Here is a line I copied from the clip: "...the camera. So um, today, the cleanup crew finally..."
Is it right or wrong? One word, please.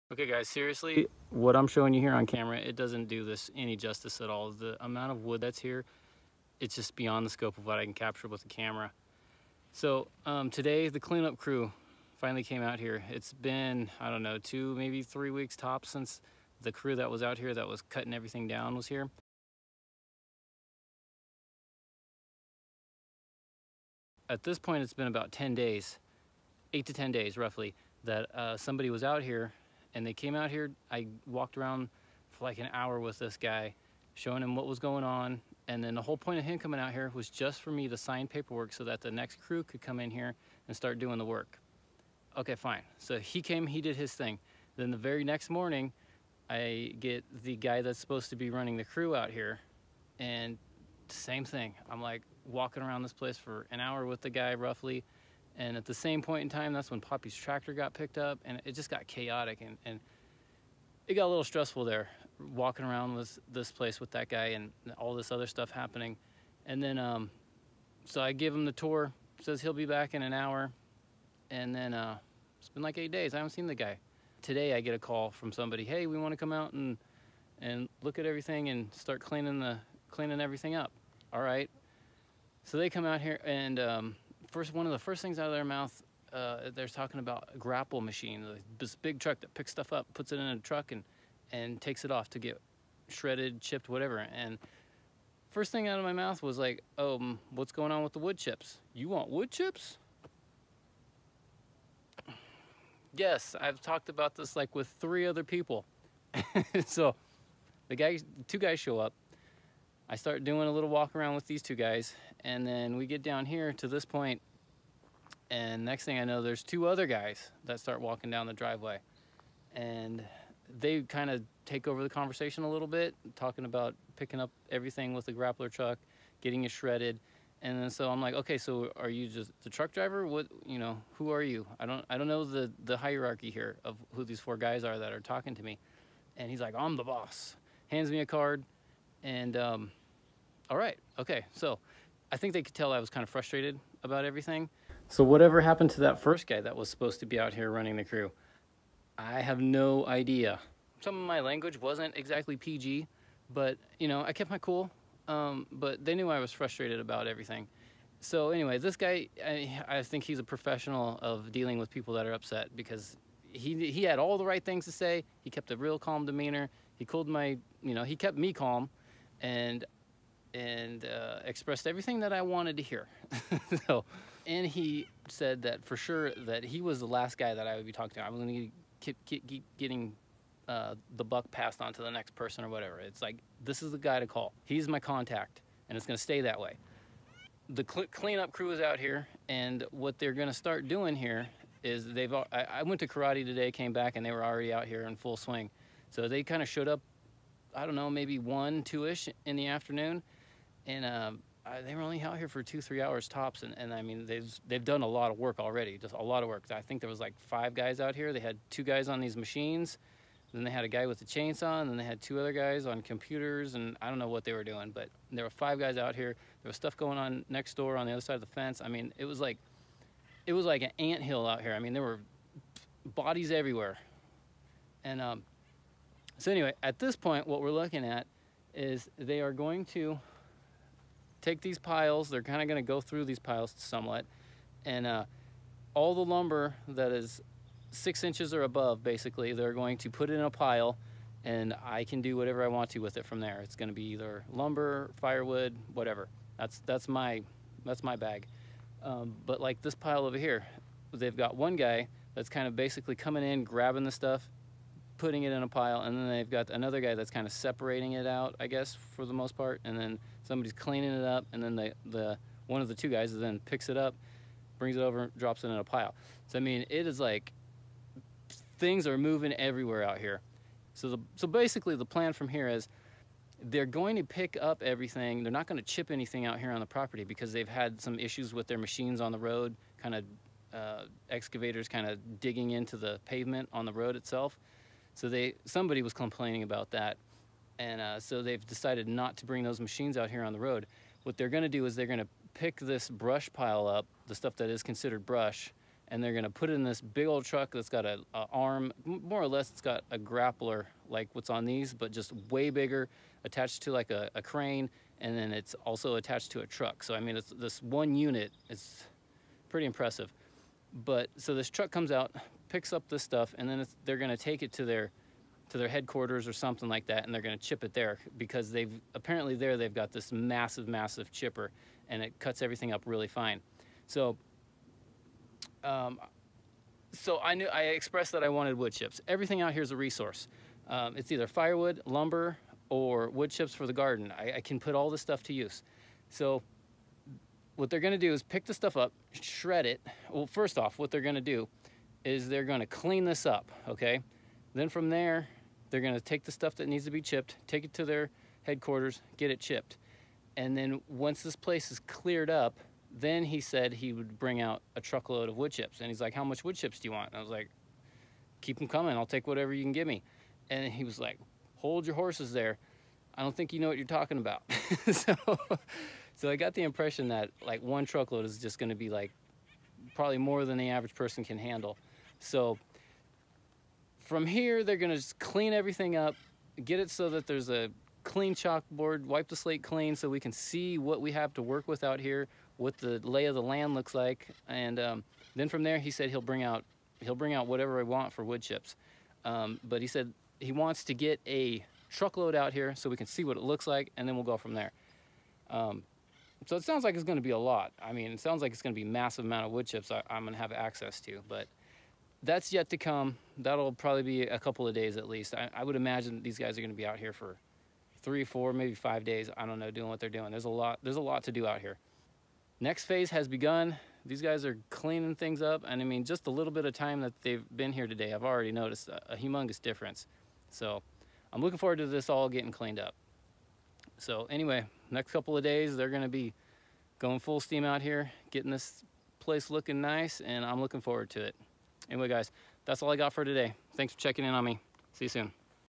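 right.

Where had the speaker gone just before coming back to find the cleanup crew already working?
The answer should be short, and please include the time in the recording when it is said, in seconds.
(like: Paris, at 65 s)
Karate, at 193 s.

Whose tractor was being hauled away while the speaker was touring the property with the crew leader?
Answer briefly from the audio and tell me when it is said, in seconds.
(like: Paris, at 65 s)
Poppy's, at 57 s.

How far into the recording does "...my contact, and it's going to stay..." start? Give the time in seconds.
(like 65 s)
184 s.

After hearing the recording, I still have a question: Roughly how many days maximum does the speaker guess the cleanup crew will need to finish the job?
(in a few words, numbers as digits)
5.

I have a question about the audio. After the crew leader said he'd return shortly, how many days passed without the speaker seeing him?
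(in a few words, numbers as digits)
8.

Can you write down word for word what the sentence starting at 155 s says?
Um, but they knew I was frustrated about everything.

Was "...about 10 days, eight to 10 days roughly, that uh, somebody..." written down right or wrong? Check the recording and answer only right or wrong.
right.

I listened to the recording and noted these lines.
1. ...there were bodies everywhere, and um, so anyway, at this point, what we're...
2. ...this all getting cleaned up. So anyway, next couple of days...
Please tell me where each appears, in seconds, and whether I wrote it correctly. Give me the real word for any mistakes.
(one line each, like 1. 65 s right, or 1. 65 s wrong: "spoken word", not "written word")
1. 221 s right
2. 422 s right.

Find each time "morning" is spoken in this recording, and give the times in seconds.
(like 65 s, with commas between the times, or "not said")
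45 s.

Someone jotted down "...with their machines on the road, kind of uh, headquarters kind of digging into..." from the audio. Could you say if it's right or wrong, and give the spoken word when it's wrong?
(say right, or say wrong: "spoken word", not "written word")
wrong: "excavators", not "headquarters".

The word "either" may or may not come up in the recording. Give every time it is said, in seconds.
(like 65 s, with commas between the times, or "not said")
244 s, 331 s.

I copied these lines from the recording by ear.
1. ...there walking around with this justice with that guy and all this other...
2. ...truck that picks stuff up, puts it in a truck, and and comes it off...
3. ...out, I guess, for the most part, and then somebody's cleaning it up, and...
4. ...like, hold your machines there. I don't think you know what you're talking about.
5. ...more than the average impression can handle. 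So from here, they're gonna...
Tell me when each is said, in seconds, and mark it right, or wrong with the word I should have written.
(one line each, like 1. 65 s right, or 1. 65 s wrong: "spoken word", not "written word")
1. 61 s wrong: "place", not "justice"
2. 89 s wrong: "takes", not "comes"
3. 258 s right
4. 361 s wrong: "horses", not "machines"
5. 370 s wrong: "person", not "impression".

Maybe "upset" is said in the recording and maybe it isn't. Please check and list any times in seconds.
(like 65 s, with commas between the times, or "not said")
162 s.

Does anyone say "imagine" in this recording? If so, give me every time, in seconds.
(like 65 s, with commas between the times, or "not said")
405 s.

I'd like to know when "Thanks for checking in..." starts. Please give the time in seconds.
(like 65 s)
433 s.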